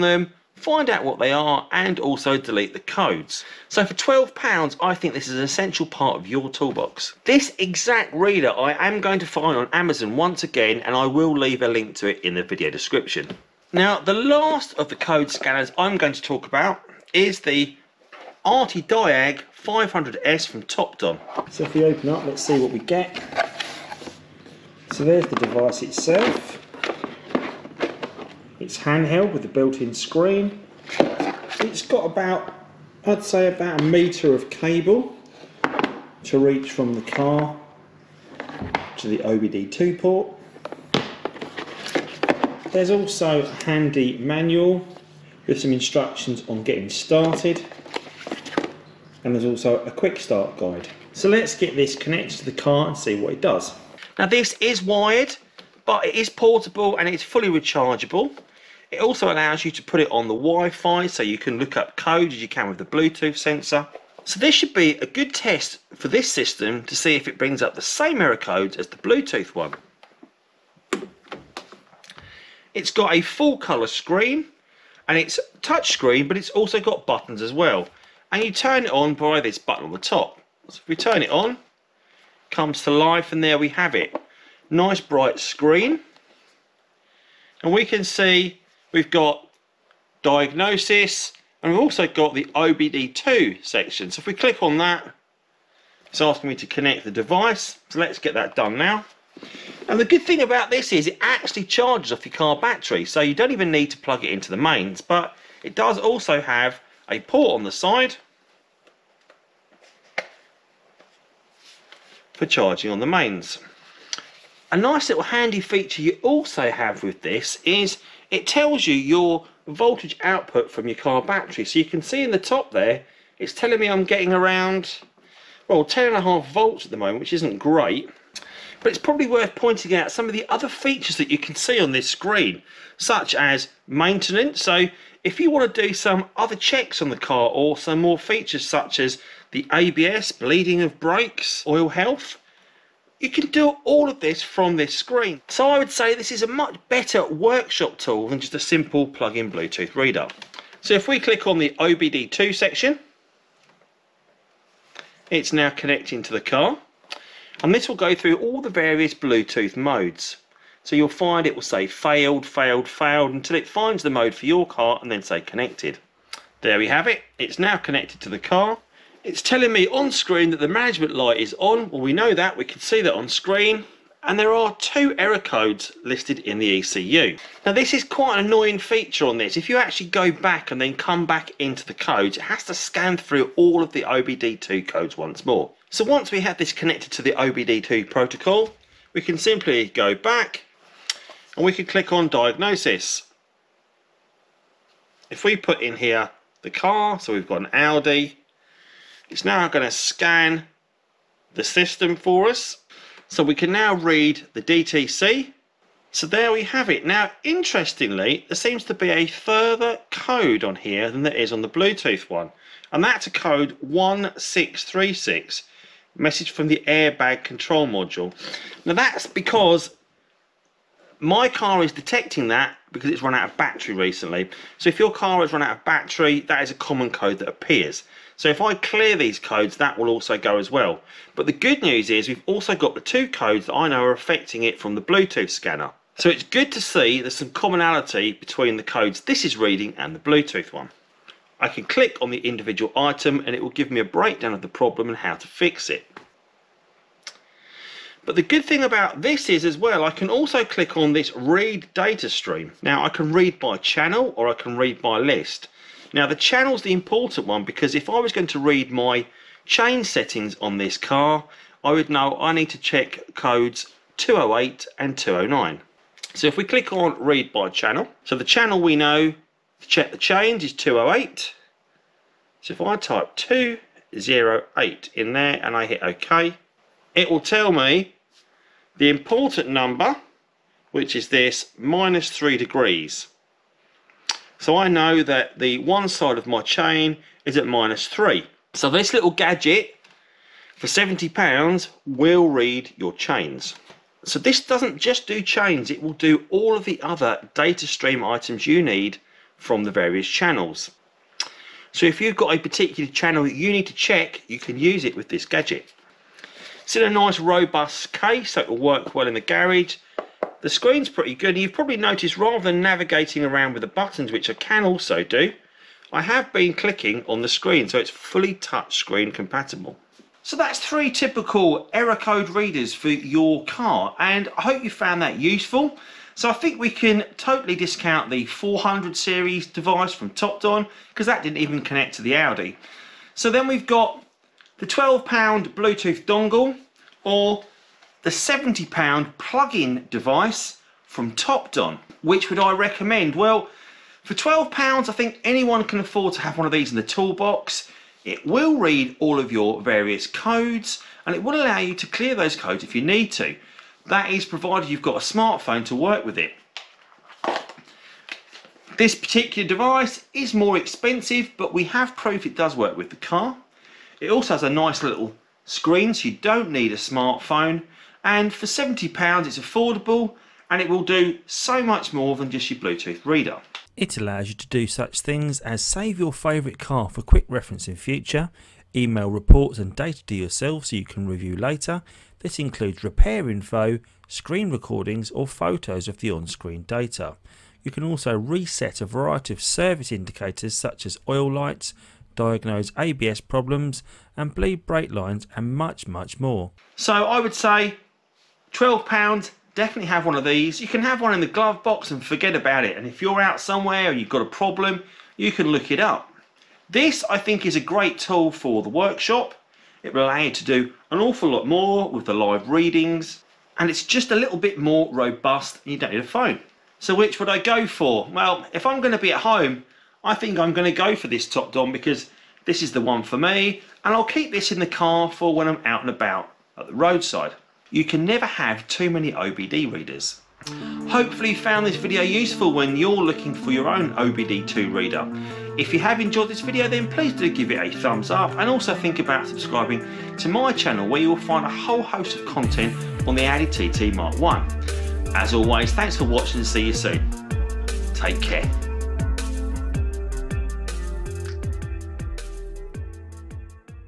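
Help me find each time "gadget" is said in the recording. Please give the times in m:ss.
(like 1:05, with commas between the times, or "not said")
4:49, 5:05.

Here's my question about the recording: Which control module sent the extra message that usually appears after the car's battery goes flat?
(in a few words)
airbag control module.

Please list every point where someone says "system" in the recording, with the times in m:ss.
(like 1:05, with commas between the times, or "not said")
1:06, 3:21.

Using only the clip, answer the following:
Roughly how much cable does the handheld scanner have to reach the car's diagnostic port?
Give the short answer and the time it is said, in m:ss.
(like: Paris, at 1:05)
about a metre, at 0:33.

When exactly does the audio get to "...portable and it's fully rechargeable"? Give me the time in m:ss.
0:56.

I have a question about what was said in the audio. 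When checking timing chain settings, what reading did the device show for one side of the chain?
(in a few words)
minus 3 degrees.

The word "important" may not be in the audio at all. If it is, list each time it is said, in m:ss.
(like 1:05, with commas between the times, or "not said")
4:16, 4:39.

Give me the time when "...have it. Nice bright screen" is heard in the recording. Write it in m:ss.
1:23.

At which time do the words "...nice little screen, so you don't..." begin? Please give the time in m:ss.
6:04.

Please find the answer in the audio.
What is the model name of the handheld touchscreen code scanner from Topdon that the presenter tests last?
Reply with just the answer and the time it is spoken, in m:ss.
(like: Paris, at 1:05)
Diag 500S, at 0:18.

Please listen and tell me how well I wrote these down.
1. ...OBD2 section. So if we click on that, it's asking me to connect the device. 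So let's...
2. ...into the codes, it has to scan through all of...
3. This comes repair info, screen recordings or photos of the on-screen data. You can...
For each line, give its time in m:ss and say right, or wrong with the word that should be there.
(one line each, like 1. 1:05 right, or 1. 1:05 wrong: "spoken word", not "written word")
1. 1:32 right
2. 3:01 right
3. 6:22 wrong: "includes", not "comes".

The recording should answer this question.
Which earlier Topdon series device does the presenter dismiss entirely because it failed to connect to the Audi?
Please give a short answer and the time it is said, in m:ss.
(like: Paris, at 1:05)
400 series, at 5:28.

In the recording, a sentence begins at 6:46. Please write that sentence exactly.
This, I think, is a great tool for the workshop.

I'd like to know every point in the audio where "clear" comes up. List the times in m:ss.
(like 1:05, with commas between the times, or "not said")
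3:48, 5:52.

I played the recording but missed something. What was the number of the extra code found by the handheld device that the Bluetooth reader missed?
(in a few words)
1636.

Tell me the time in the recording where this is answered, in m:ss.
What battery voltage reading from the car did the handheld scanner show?
2:05.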